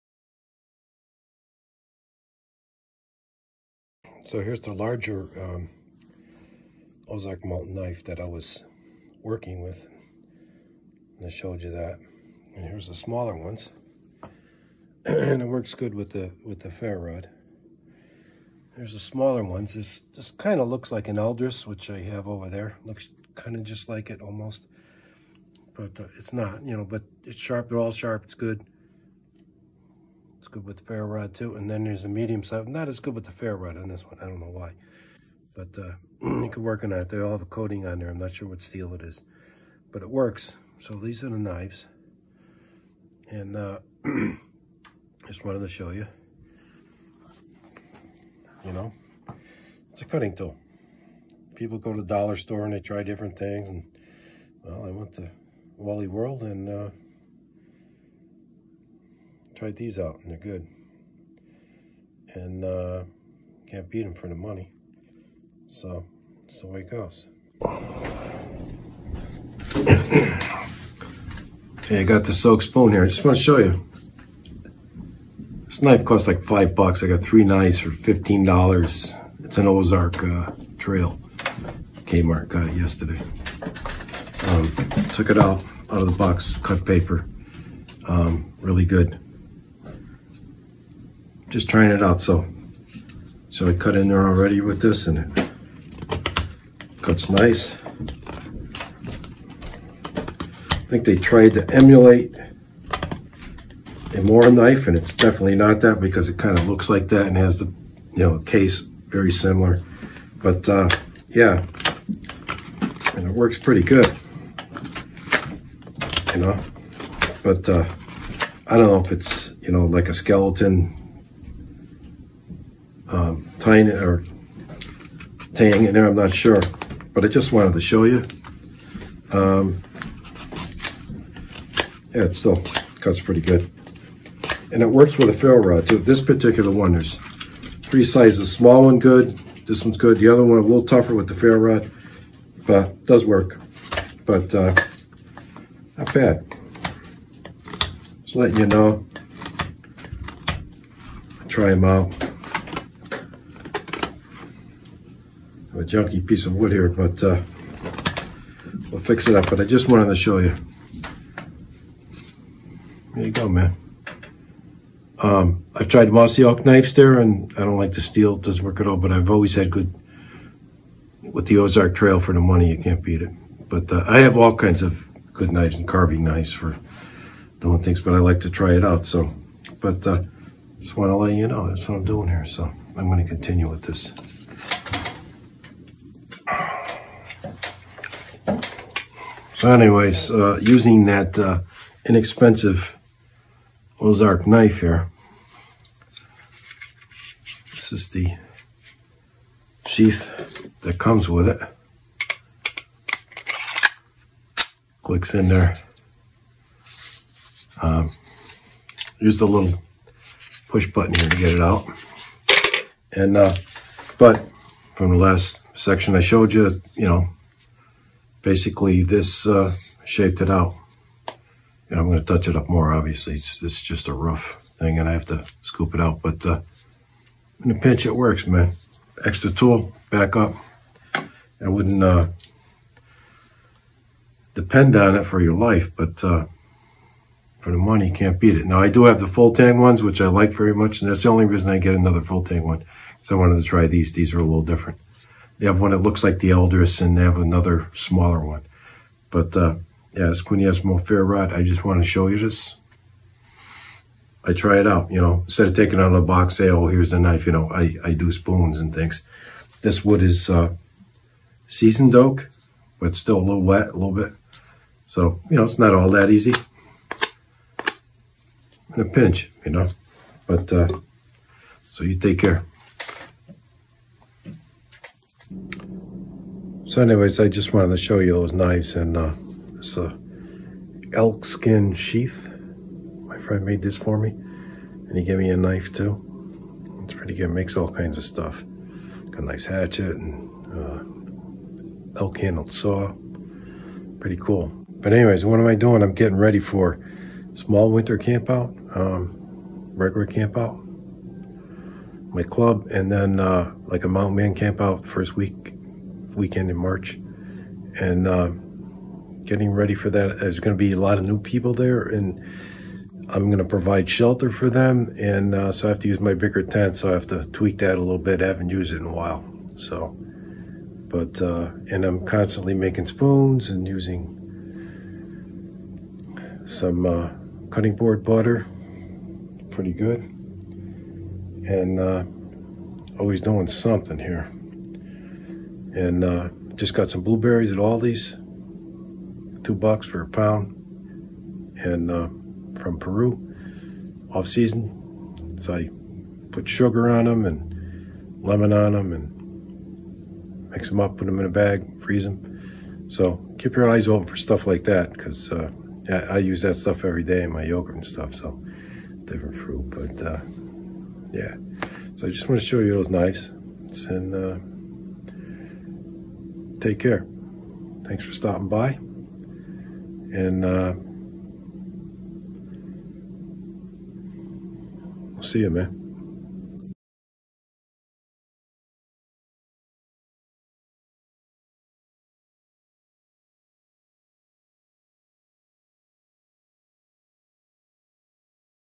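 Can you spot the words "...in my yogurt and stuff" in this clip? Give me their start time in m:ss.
5:57.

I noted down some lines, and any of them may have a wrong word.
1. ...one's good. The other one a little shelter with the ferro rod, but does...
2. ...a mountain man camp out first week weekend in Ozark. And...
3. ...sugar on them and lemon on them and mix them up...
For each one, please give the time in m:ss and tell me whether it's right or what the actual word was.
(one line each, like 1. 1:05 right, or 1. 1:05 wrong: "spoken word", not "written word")
1. 2:19 wrong: "tougher", not "shelter"
2. 5:04 wrong: "March", not "Ozark"
3. 5:46 right.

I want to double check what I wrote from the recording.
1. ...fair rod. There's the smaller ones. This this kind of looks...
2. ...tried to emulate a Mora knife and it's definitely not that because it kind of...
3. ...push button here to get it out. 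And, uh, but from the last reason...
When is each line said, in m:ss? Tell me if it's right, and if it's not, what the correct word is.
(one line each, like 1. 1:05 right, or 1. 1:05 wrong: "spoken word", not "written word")
1. 0:16 right
2. 1:41 right
3. 3:30 wrong: "section", not "reason".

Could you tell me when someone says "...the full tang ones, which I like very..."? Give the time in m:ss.
3:59.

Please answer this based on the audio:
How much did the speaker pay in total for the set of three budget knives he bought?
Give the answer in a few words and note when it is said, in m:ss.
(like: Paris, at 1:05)
$15, at 1:17.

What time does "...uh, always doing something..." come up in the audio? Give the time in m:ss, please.
5:31.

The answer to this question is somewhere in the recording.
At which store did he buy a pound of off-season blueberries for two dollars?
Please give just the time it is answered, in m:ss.
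5:37.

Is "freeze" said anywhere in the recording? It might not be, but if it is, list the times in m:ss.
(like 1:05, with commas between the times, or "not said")
5:52.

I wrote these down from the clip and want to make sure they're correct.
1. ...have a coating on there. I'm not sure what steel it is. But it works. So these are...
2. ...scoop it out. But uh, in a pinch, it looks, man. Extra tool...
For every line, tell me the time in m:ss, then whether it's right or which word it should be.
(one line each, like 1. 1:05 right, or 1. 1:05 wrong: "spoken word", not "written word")
1. 0:37 right
2. 3:45 wrong: "works", not "looks".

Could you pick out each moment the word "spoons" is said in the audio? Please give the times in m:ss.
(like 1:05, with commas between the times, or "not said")
1:12, 4:18, 5:23.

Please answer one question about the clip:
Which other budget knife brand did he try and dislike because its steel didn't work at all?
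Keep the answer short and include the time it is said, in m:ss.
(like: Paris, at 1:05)
Mossy Oak, at 2:46.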